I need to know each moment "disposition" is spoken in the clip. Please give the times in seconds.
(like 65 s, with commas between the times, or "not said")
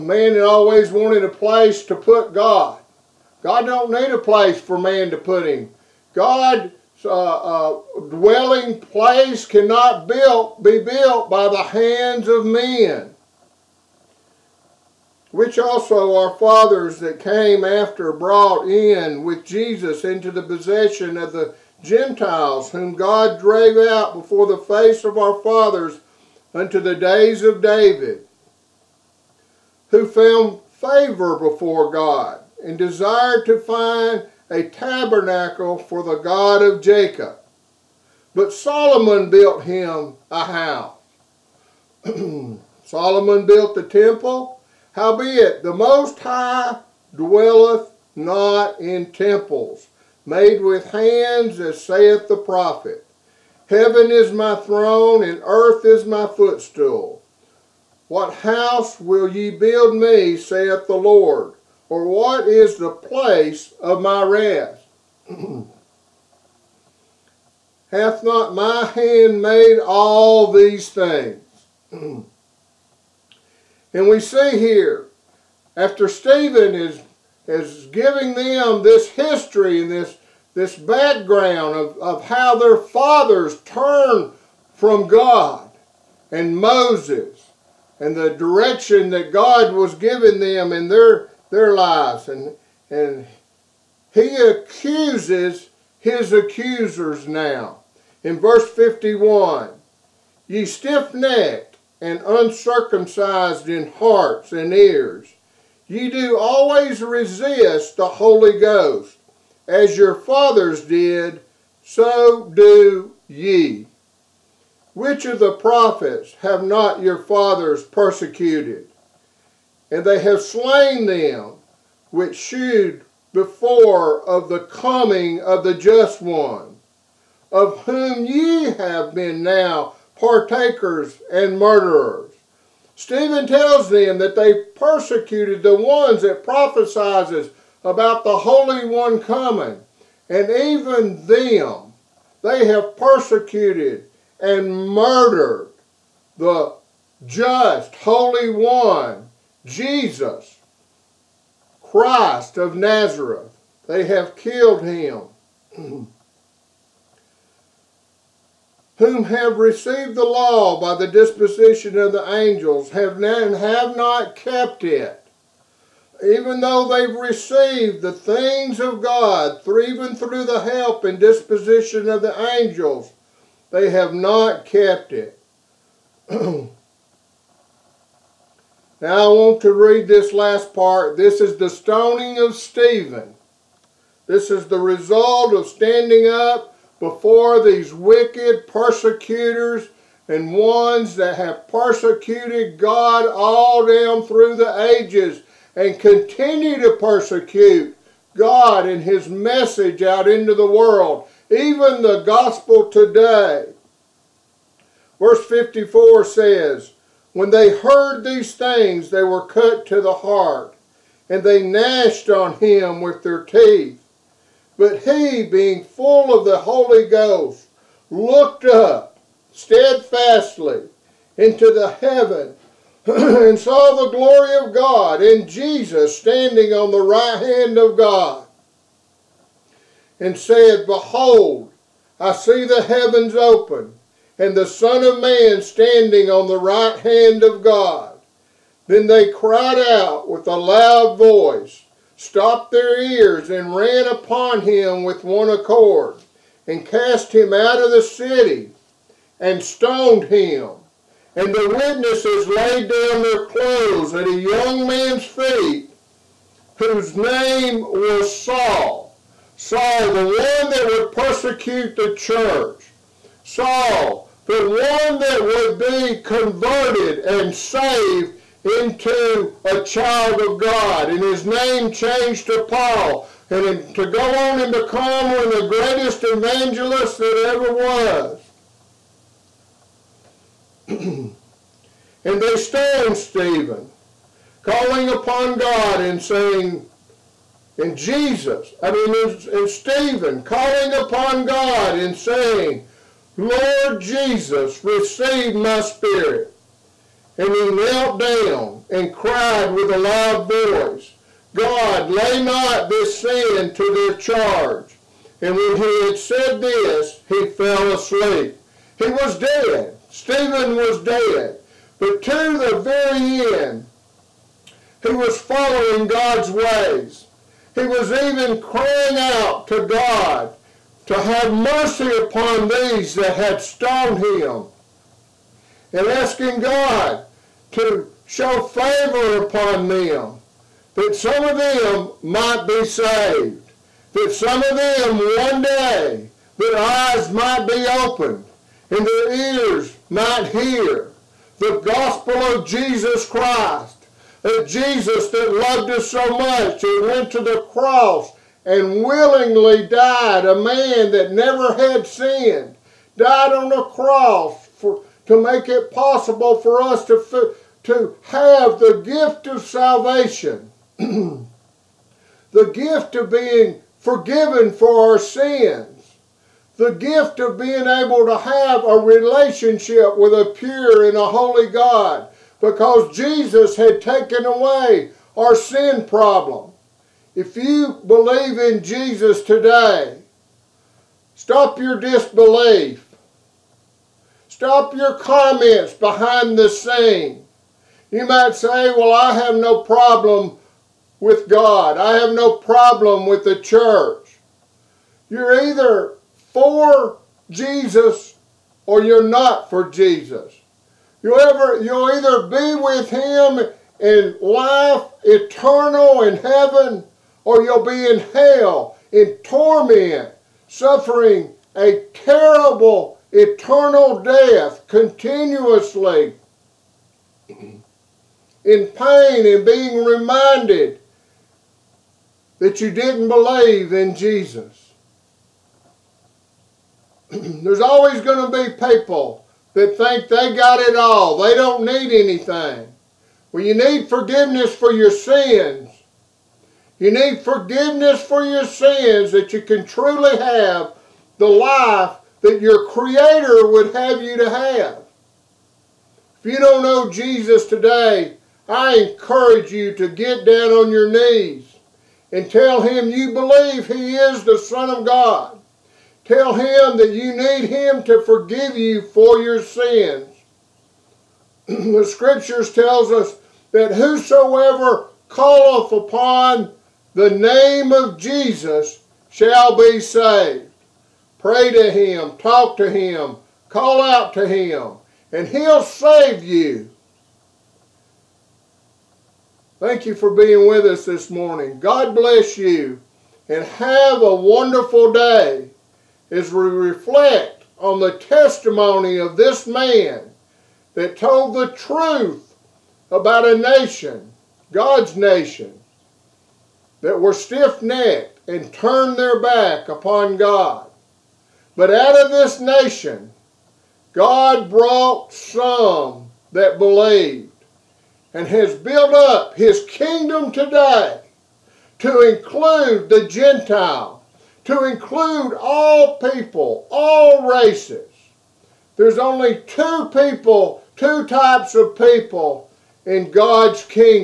161 s, 171 s.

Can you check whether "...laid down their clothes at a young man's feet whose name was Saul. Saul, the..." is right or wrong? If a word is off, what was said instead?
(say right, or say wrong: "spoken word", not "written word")
right.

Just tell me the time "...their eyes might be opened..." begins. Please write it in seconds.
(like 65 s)
336 s.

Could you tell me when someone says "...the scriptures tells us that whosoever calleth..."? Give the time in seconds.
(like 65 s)
461 s.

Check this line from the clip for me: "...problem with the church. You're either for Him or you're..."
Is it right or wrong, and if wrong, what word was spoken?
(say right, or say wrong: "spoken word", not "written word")
wrong: "Jesus", not "Him".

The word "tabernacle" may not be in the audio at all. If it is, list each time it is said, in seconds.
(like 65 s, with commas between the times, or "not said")
34 s.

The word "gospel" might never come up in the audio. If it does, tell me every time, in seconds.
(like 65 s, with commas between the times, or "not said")
202 s, 341 s.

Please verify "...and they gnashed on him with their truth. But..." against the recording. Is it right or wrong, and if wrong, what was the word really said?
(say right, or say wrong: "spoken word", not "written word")
wrong: "teeth", not "truth".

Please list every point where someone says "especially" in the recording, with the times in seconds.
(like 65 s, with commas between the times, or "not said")
not said.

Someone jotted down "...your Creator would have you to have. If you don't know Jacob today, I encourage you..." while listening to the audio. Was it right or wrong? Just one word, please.
wrong.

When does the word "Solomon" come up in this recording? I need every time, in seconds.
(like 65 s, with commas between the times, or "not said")
38 s, 42 s.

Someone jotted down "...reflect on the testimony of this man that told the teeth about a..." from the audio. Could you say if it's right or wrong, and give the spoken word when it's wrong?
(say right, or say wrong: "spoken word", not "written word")
wrong: "truth", not "teeth".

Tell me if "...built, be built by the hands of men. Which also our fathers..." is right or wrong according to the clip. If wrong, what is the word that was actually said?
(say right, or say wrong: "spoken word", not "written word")
right.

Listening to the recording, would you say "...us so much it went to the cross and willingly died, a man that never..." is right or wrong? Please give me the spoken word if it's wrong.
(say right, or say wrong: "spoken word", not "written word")
right.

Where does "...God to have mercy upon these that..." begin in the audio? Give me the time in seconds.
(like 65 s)
319 s.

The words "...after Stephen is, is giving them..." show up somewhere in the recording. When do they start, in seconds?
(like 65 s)
75 s.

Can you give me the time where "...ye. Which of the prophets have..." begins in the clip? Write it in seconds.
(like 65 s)
113 s.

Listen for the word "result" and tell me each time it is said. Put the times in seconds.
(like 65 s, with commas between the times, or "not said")
184 s.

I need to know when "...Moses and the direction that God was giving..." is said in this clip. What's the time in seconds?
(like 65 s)
86 s.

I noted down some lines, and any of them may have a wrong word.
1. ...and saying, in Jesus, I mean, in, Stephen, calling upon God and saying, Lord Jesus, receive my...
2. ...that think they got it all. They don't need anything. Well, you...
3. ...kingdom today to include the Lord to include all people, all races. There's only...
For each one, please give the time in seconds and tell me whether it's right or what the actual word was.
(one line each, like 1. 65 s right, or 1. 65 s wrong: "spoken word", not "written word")
1. 285 s right
2. 429 s right
3. 509 s wrong: "Gentiles", not "Lord".